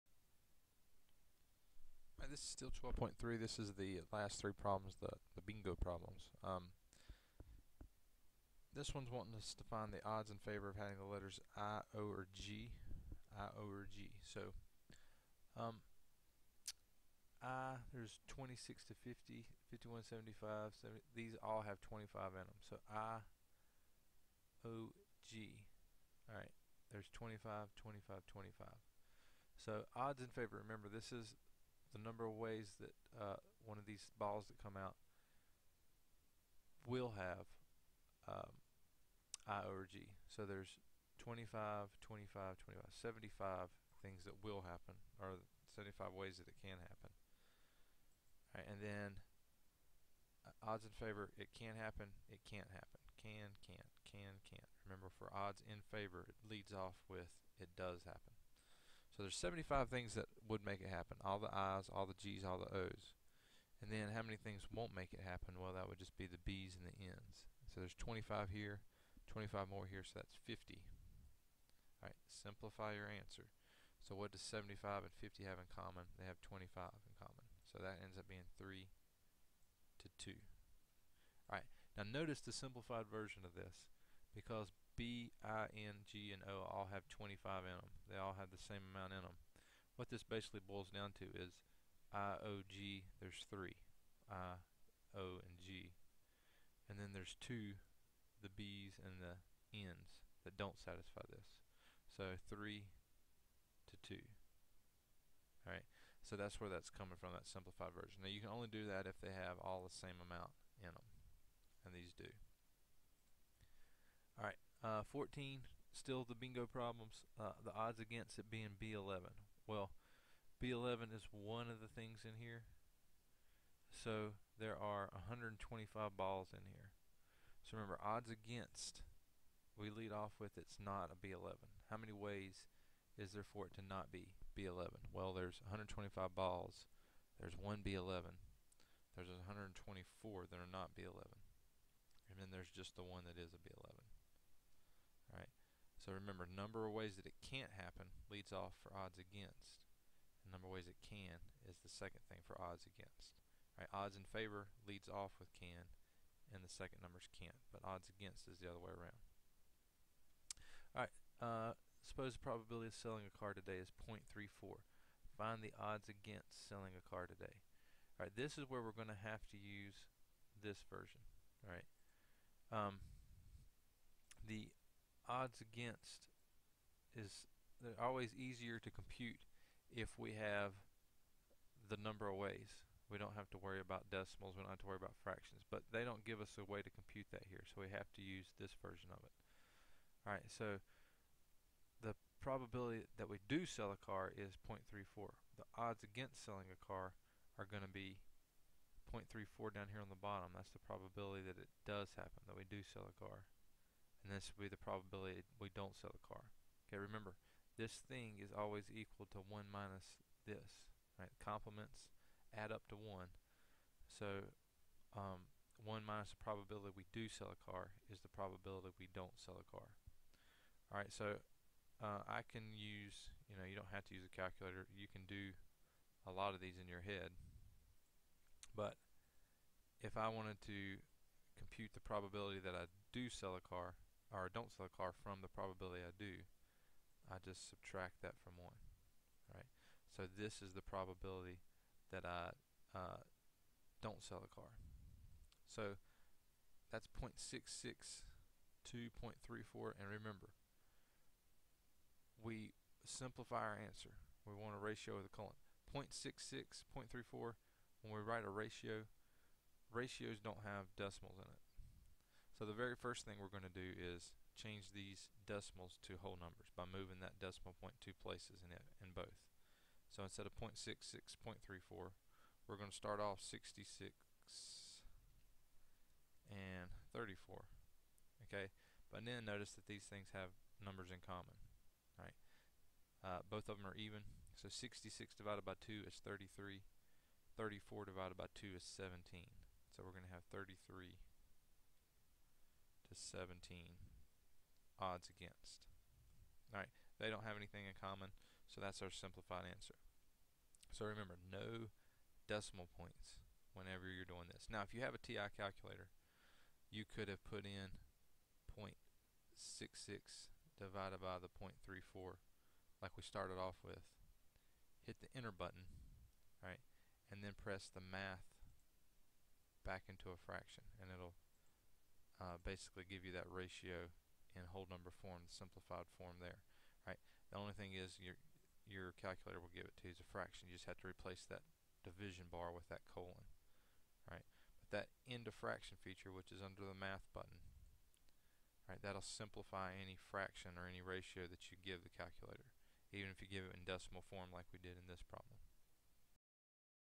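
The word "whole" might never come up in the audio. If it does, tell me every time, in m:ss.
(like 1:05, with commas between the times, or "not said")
4:26, 5:24.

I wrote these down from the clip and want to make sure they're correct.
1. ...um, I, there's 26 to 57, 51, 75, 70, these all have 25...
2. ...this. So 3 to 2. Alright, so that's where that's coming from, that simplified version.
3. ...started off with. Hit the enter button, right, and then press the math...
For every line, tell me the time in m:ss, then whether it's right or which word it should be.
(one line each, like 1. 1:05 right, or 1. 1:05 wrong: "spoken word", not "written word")
1. 0:15 wrong: "50", not "57"
2. 1:41 right
3. 5:13 right.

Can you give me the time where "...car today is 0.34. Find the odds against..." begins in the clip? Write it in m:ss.
2:43.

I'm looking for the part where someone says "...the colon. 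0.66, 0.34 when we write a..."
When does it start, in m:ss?
4:15.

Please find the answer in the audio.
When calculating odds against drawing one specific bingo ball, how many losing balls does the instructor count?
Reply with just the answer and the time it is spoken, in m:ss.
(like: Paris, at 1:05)
124, at 2:19.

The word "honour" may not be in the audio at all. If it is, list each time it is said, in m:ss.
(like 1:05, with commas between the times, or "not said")
not said.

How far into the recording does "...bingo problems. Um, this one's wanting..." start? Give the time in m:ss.
0:05.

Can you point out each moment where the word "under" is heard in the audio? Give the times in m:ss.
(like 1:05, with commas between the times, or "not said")
5:36.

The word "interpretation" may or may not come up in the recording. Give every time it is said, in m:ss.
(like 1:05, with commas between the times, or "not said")
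not said.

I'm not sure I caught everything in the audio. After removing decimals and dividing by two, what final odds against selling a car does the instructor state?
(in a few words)
33 to 17.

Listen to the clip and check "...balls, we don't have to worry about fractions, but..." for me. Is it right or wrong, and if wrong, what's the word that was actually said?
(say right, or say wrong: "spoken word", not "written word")
wrong: "decimals", not "balls".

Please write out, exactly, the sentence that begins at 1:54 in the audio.
Alright, uh, 14, still the bingo problems, uh, the odds against it being B11.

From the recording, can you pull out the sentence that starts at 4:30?
So instead of 0.66, 0.34, we're going to start off 66 and 34.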